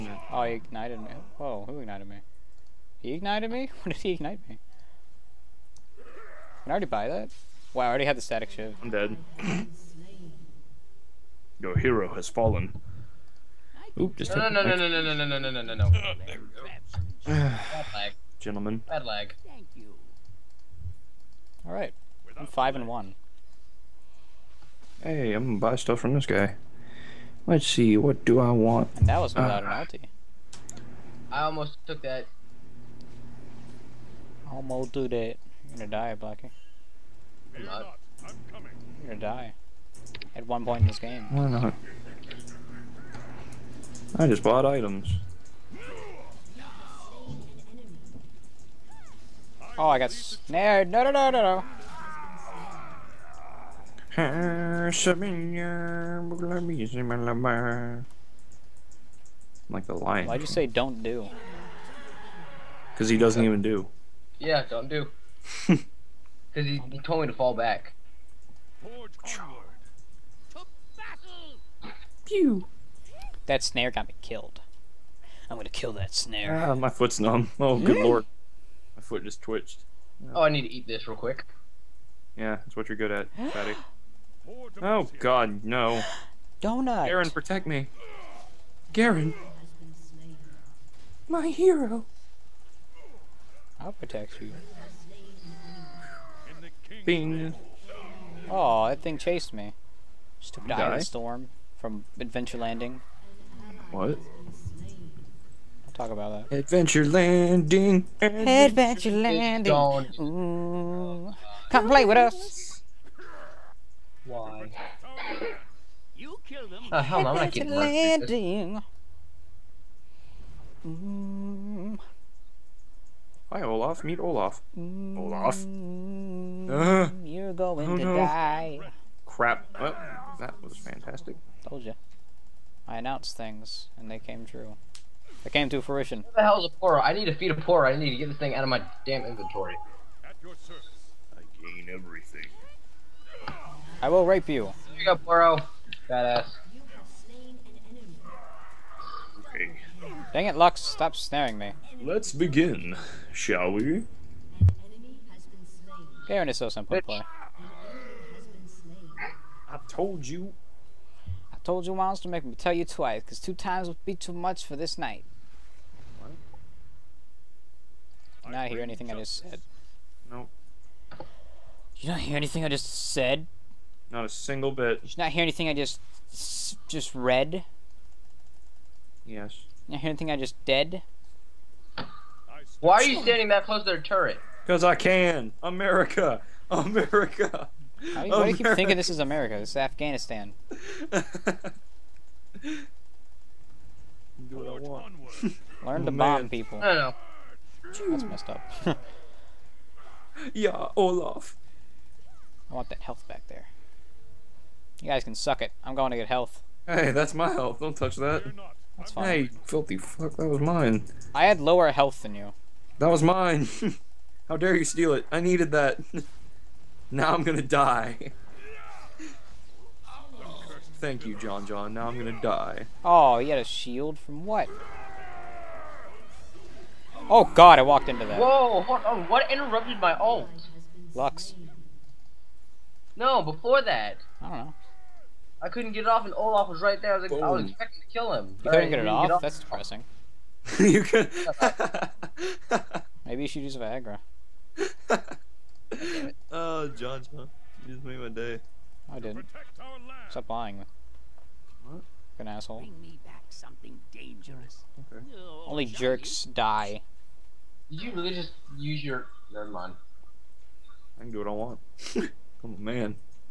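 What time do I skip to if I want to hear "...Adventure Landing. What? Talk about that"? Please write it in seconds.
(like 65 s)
102 s.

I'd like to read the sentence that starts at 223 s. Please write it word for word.
Oh, he had a shield from what?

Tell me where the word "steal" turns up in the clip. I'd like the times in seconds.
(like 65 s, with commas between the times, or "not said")
214 s.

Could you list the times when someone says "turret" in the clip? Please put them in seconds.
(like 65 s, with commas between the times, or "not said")
184 s.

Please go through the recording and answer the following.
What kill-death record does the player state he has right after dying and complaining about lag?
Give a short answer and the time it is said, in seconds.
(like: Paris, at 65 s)
5 and 1, at 22 s.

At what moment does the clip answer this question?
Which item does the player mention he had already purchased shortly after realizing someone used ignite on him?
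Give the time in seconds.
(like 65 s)
8 s.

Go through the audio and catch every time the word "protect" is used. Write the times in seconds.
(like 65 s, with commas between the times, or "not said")
87 s, 93 s.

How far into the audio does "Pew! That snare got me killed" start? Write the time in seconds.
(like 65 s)
72 s.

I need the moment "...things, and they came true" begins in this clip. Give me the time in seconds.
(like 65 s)
133 s.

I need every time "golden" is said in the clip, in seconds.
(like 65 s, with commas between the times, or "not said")
not said.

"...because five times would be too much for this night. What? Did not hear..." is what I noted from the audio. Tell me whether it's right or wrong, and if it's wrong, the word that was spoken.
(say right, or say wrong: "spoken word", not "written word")
wrong: "two", not "five".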